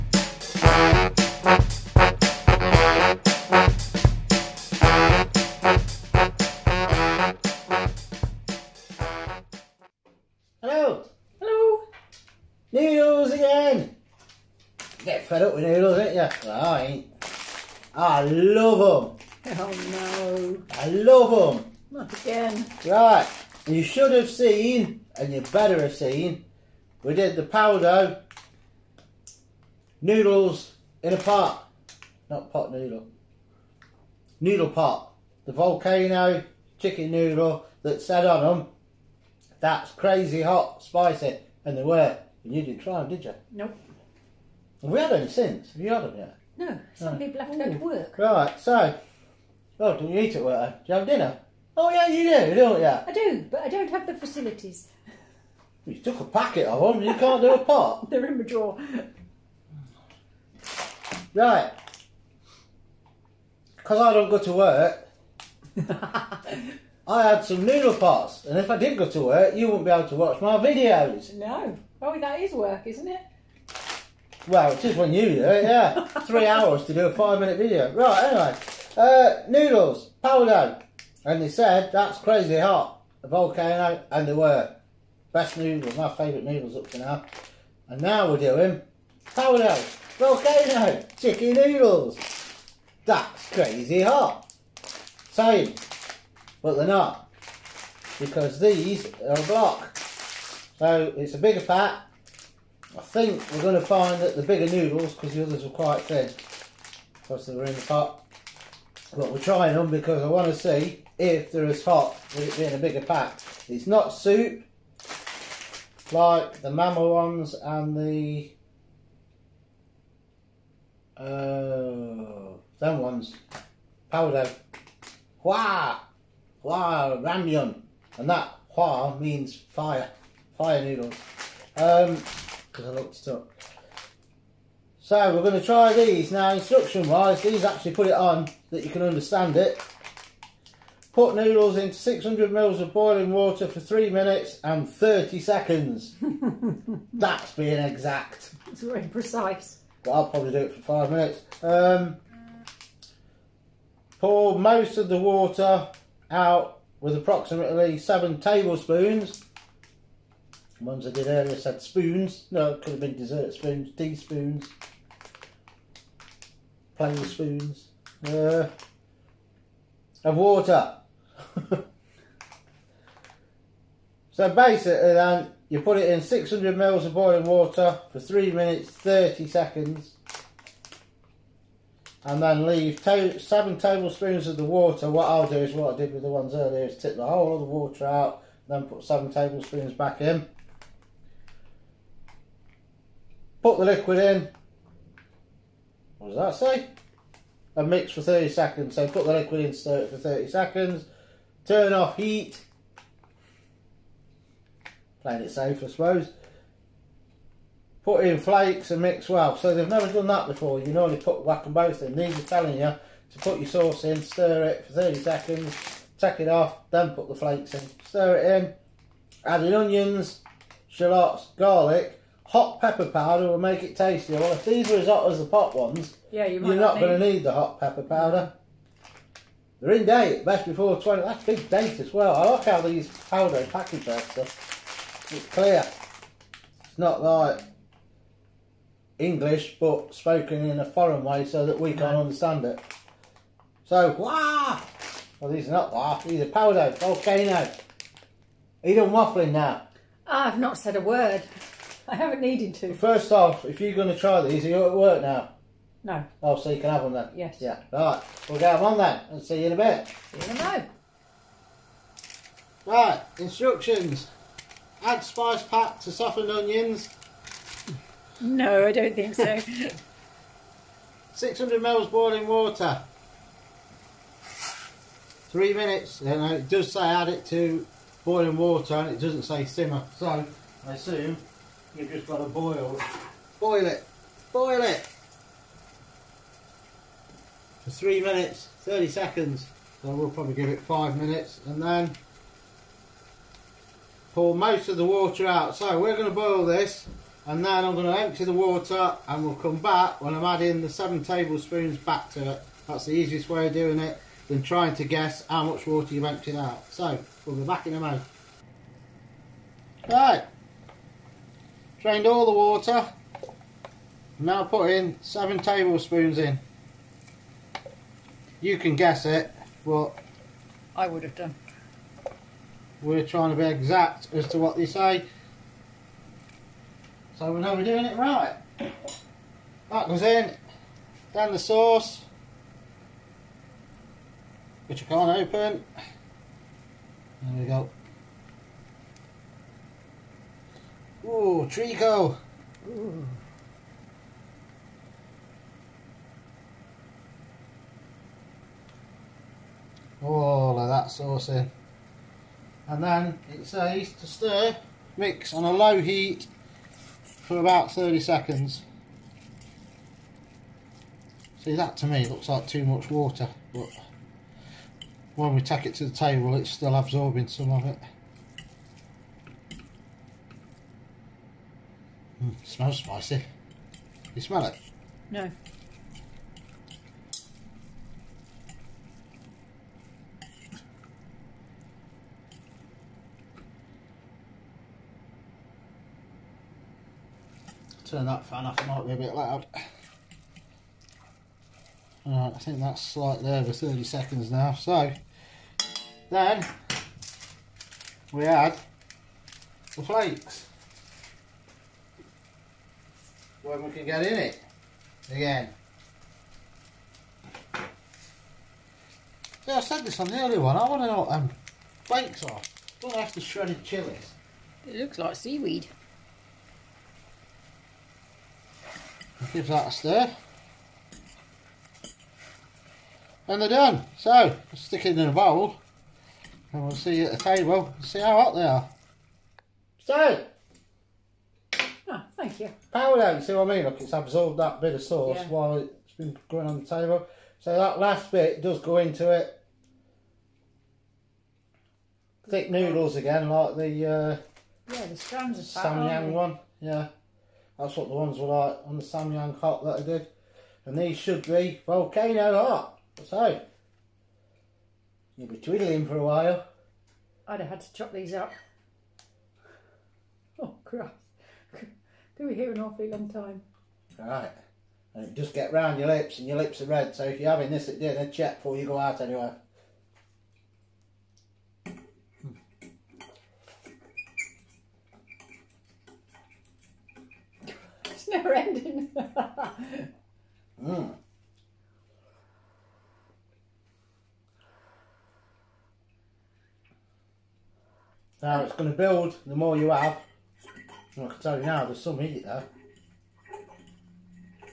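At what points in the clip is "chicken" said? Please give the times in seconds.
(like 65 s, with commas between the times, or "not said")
36 s, 91 s.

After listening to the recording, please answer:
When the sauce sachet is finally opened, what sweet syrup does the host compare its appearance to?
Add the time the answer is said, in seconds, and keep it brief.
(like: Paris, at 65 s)
treacle, at 341 s.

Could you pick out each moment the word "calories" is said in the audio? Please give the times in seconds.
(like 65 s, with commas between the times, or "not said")
not said.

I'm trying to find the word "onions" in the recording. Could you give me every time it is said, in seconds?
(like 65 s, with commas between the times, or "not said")
219 s, 266 s.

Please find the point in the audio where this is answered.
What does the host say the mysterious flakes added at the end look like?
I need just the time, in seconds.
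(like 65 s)
415 s.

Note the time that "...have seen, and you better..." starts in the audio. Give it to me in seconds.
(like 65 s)
24 s.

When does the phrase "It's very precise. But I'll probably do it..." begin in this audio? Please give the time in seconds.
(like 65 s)
148 s.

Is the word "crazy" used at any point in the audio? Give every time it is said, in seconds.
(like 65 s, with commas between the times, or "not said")
39 s, 82 s, 93 s.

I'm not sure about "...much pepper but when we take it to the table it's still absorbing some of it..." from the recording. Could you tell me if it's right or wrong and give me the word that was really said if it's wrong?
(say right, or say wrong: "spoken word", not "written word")
wrong: "water", not "pepper".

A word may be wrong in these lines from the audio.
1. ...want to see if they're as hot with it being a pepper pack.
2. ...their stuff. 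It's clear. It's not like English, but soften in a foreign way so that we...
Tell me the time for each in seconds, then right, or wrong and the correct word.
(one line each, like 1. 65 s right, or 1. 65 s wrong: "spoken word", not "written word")
1. 110 s wrong: "bigger", not "pepper"
2. 234 s wrong: "spoken", not "soften".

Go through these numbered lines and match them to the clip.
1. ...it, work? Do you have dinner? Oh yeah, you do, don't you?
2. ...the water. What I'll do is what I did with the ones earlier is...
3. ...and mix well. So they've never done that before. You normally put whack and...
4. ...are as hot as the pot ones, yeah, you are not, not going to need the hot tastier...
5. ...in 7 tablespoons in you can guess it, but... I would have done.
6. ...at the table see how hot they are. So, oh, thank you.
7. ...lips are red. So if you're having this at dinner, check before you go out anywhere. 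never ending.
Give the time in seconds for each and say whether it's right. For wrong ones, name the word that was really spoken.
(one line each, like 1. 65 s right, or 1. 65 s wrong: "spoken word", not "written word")
1. 50 s right
2. 184 s right
3. 208 s right
4. 224 s wrong: "pepper", not "tastier"
5. 314 s right
6. 427 s right
7. 466 s right.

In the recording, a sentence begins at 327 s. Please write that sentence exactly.
So we know we're doing it right.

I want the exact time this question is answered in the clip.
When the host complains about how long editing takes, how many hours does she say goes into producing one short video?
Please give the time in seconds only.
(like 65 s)
76 s.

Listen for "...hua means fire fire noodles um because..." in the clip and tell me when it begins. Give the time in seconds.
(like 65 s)
128 s.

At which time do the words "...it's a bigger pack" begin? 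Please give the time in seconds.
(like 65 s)
101 s.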